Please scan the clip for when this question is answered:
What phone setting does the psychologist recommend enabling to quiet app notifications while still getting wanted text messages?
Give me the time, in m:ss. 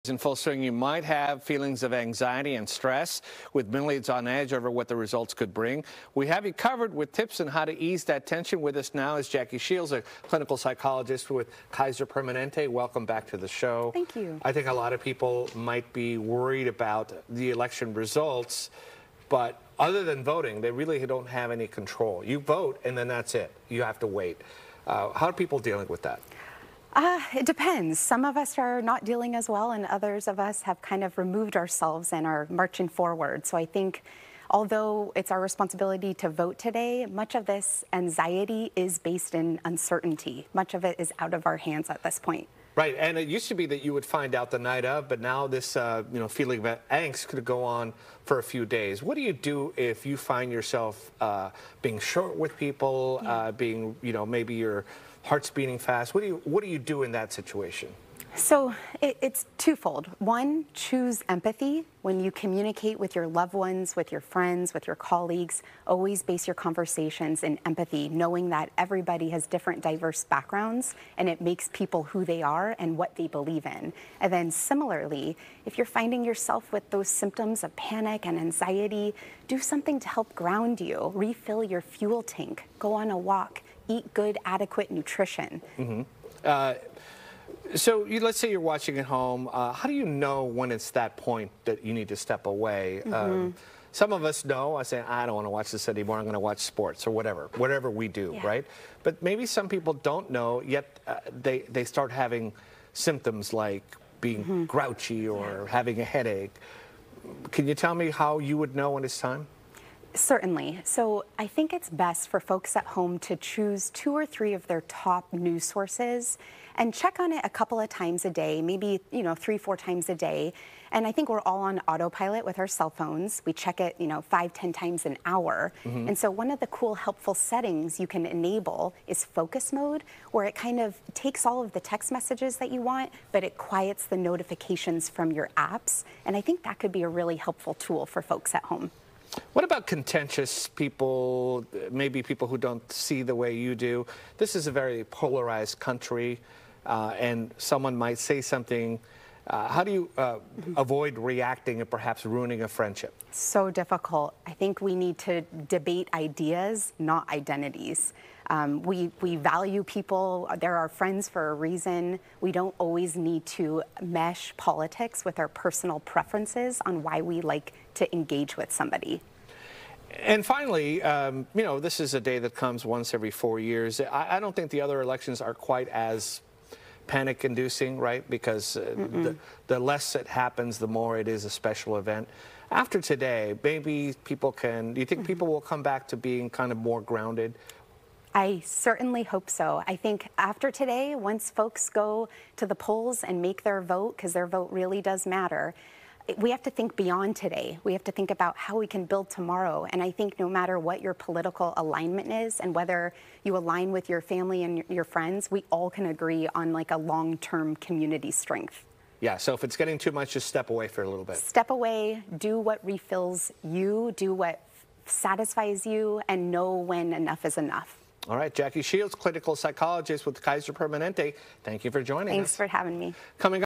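2:09.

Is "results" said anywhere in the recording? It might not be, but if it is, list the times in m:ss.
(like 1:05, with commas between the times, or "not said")
0:04, 0:17.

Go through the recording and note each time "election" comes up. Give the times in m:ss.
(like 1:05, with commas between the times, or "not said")
0:17, 2:54.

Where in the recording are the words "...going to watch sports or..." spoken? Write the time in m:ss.
1:36.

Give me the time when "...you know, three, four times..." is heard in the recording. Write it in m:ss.
1:59.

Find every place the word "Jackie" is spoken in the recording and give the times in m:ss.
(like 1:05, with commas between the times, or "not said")
0:09, 3:38.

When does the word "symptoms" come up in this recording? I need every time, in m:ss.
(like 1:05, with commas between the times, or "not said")
1:17, 1:42.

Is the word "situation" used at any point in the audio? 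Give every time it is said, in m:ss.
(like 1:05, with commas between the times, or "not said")
0:57.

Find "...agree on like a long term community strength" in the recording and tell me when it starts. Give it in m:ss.
3:26.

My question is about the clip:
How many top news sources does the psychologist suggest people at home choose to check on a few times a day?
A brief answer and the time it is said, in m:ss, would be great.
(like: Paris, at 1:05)
2 or 3, at 1:53.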